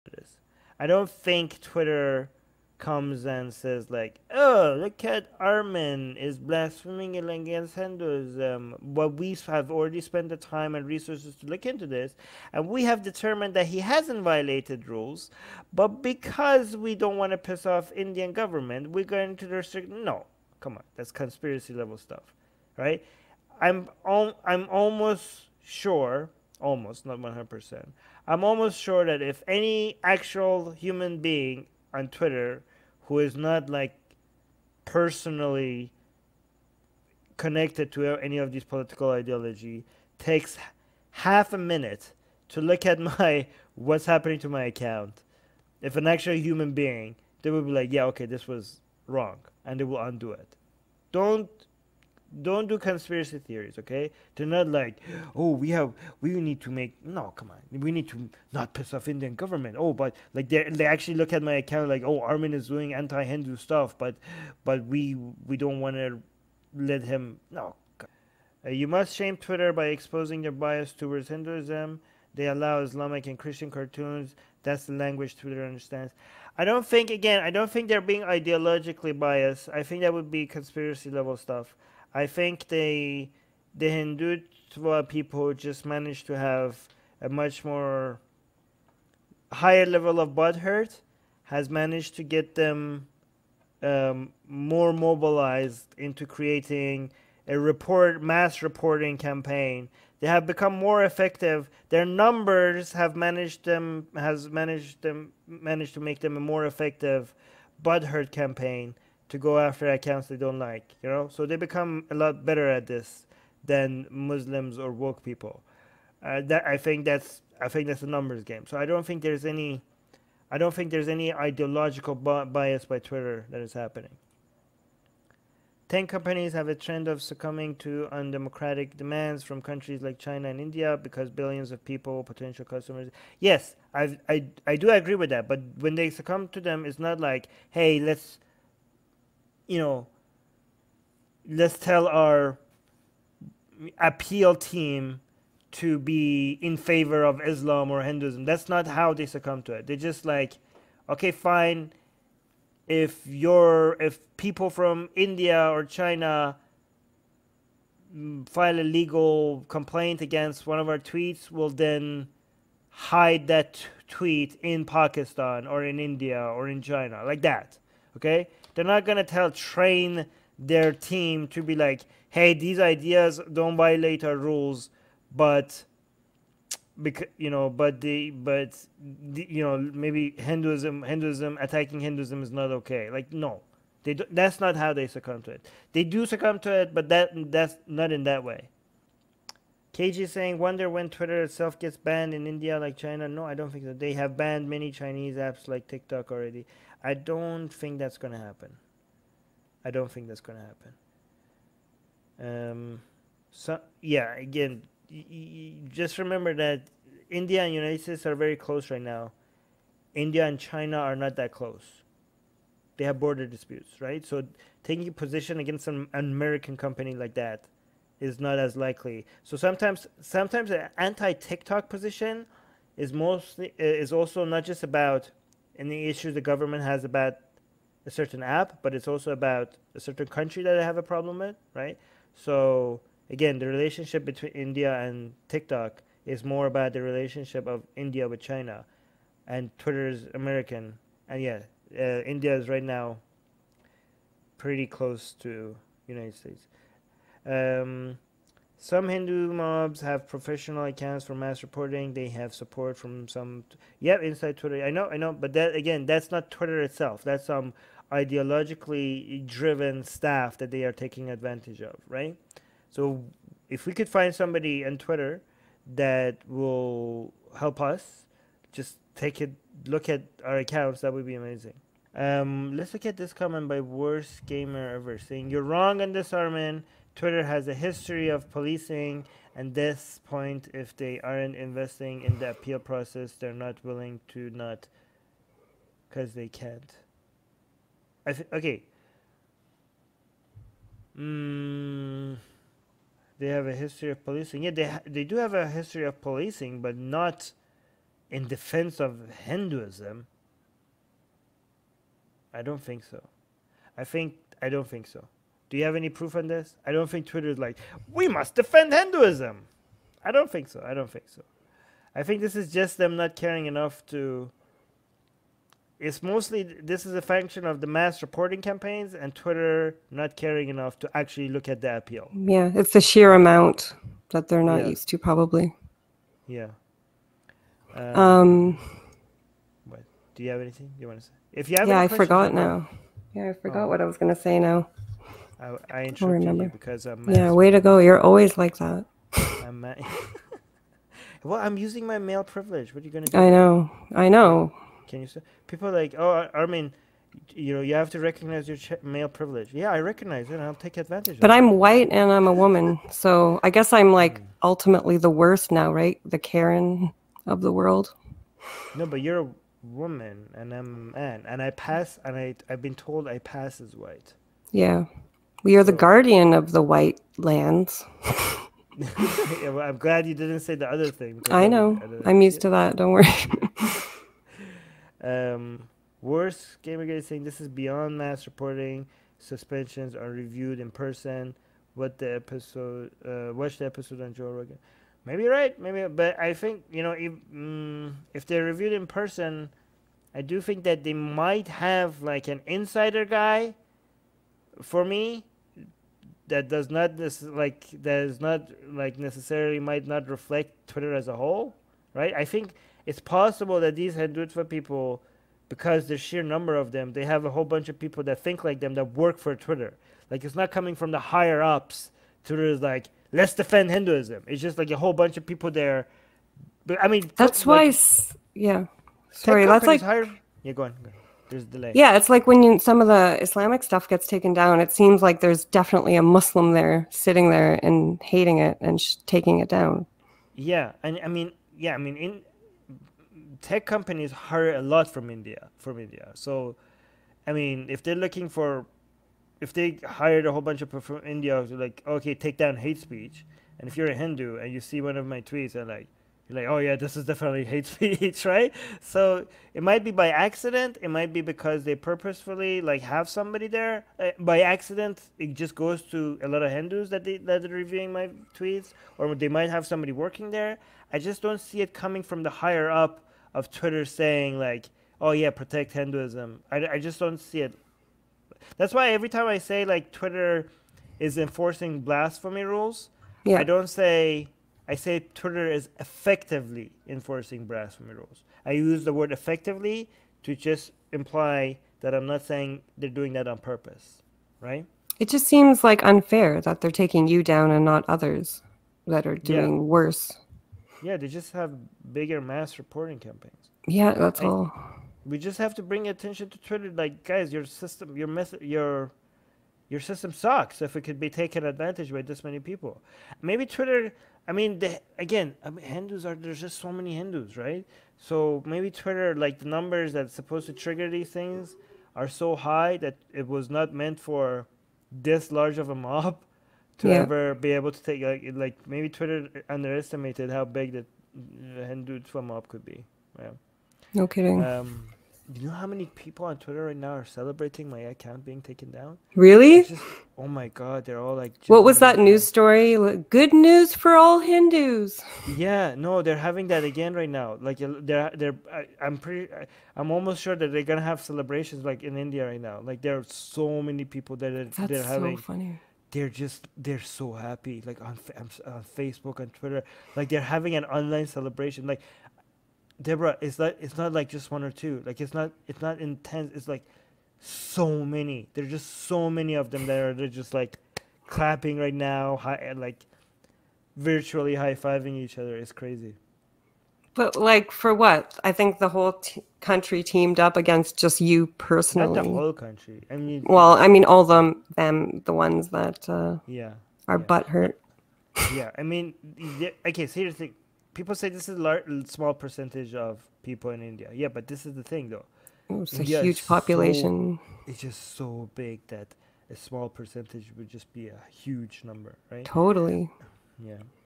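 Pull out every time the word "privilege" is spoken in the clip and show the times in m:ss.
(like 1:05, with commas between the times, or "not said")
5:42, 5:49.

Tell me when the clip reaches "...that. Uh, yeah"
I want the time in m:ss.
9:35.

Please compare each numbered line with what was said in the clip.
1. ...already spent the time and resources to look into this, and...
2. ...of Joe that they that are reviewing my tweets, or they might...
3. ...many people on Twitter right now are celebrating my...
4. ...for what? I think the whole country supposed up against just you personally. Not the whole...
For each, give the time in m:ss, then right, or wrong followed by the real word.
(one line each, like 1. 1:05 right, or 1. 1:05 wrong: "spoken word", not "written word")
1. 0:09 right
2. 7:36 wrong: "Hindus", not "Joe"
3. 8:45 right
4. 9:27 wrong: "teamed", not "supposed".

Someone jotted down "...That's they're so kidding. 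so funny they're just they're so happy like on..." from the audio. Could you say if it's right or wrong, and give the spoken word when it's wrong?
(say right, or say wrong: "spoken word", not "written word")
wrong: "having", not "kidding".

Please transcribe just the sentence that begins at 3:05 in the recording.
They do succumb to it, but that that's not in that way.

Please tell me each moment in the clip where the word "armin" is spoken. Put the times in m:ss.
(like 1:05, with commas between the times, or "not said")
0:05, 1:02, 4:36.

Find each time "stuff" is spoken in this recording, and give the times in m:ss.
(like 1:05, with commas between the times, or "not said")
0:21, 1:03, 1:21, 7:03.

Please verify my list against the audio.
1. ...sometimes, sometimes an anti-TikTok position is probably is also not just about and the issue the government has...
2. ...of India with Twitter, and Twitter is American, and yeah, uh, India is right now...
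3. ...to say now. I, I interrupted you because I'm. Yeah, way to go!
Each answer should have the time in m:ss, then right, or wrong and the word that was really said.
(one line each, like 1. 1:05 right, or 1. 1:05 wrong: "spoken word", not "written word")
1. 3:39 wrong: "mostly", not "probably"
2. 3:57 wrong: "China", not "Twitter"
3. 5:34 right.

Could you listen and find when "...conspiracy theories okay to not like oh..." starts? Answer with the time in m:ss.
0:52.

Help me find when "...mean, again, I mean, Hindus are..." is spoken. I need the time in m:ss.
8:24.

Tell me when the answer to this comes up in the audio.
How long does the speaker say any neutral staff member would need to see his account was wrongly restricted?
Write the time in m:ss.
0:41.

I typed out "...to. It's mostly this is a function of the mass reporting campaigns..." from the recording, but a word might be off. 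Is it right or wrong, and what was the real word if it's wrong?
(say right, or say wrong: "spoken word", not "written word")
right.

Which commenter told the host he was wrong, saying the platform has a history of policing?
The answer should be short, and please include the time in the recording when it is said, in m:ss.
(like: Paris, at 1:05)
worst gamer ever, at 4:33.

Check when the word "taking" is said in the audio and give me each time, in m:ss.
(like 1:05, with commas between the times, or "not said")
3:34, 4:20, 7:09, 8:06.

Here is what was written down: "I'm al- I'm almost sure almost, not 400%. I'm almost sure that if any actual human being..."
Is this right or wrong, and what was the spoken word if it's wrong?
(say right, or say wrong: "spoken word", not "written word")
wrong: "100", not "400".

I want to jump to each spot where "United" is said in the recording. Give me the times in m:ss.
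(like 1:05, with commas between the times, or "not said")
3:27, 4:06.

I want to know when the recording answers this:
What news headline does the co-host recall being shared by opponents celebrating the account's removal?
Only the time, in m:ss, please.
8:53.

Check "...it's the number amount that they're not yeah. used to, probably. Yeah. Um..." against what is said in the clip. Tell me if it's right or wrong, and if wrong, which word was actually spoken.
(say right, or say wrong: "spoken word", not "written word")
wrong: "sheer", not "number".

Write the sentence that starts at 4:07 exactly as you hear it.
Um, some Hindu mobs have professional accounts for mass reporting.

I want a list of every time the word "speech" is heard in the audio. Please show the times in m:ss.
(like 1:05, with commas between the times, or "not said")
7:22, 7:27.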